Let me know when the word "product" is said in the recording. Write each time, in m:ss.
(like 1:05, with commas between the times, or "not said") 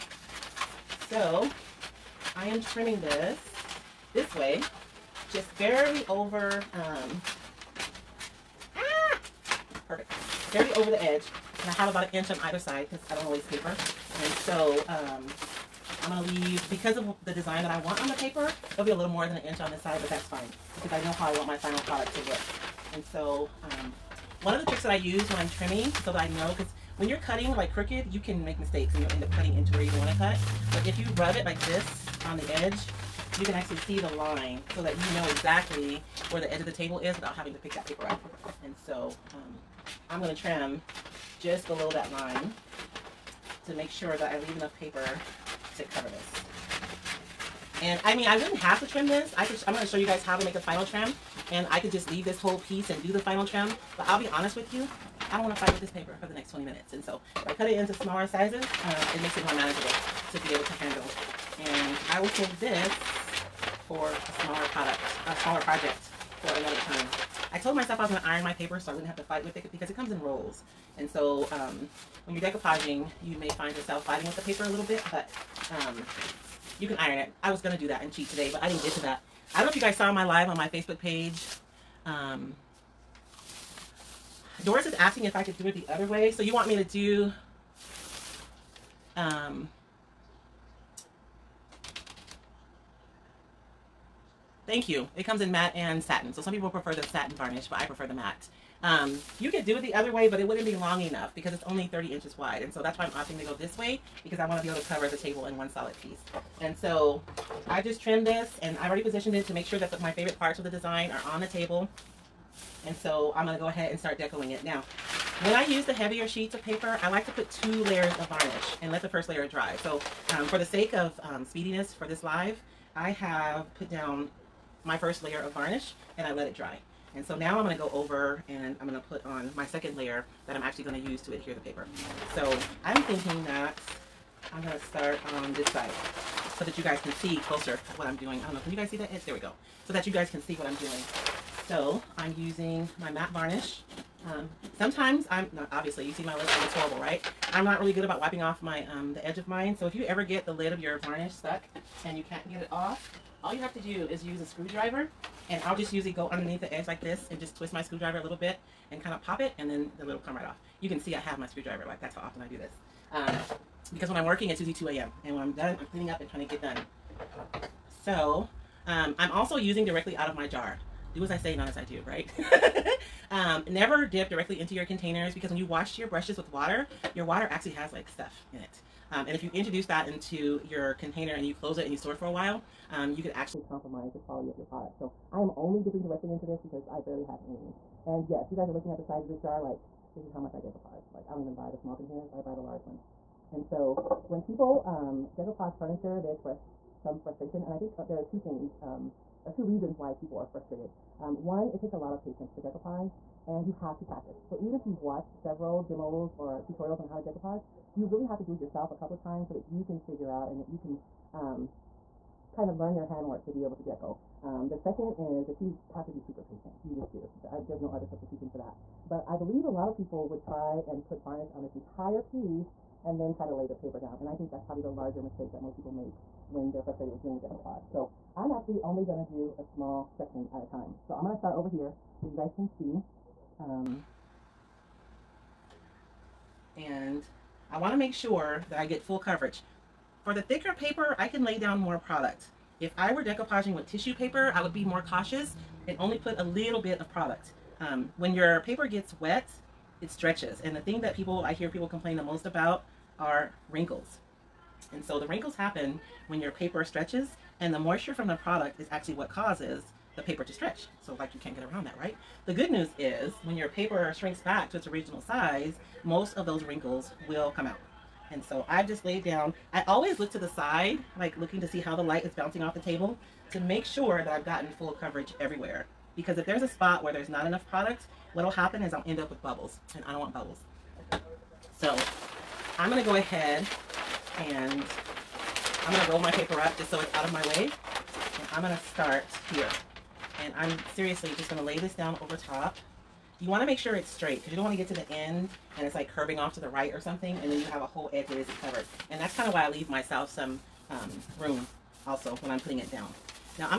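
0:21, 1:04, 3:04, 4:01, 4:07, 4:18, 4:37.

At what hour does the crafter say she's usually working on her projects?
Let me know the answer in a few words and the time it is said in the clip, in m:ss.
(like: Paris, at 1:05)
2 a.m., at 2:44.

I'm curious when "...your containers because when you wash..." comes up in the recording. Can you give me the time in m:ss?
2:54.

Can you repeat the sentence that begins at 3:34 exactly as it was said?
Um, the second is that you have to be super patient.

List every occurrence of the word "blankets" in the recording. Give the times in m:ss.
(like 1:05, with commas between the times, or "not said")
not said.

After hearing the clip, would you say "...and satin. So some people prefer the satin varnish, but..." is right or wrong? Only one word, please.
right.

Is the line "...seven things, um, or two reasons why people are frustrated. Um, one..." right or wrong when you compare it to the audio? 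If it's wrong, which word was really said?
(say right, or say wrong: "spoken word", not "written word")
wrong: "two", not "seven".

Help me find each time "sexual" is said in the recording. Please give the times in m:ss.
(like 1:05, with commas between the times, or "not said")
not said.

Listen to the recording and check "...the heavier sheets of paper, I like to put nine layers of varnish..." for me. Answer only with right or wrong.
wrong.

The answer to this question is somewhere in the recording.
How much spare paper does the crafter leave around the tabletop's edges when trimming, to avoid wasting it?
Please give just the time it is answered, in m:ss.
0:11.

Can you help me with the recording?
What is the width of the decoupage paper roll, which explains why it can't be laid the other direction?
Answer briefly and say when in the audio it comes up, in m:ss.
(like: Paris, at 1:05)
30 inches, at 1:41.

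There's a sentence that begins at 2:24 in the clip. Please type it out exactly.
Um, sometimes I'm not, obviously, you see my lips, It's horrible, right?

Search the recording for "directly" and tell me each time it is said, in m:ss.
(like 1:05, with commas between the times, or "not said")
2:49, 2:54, 3:06.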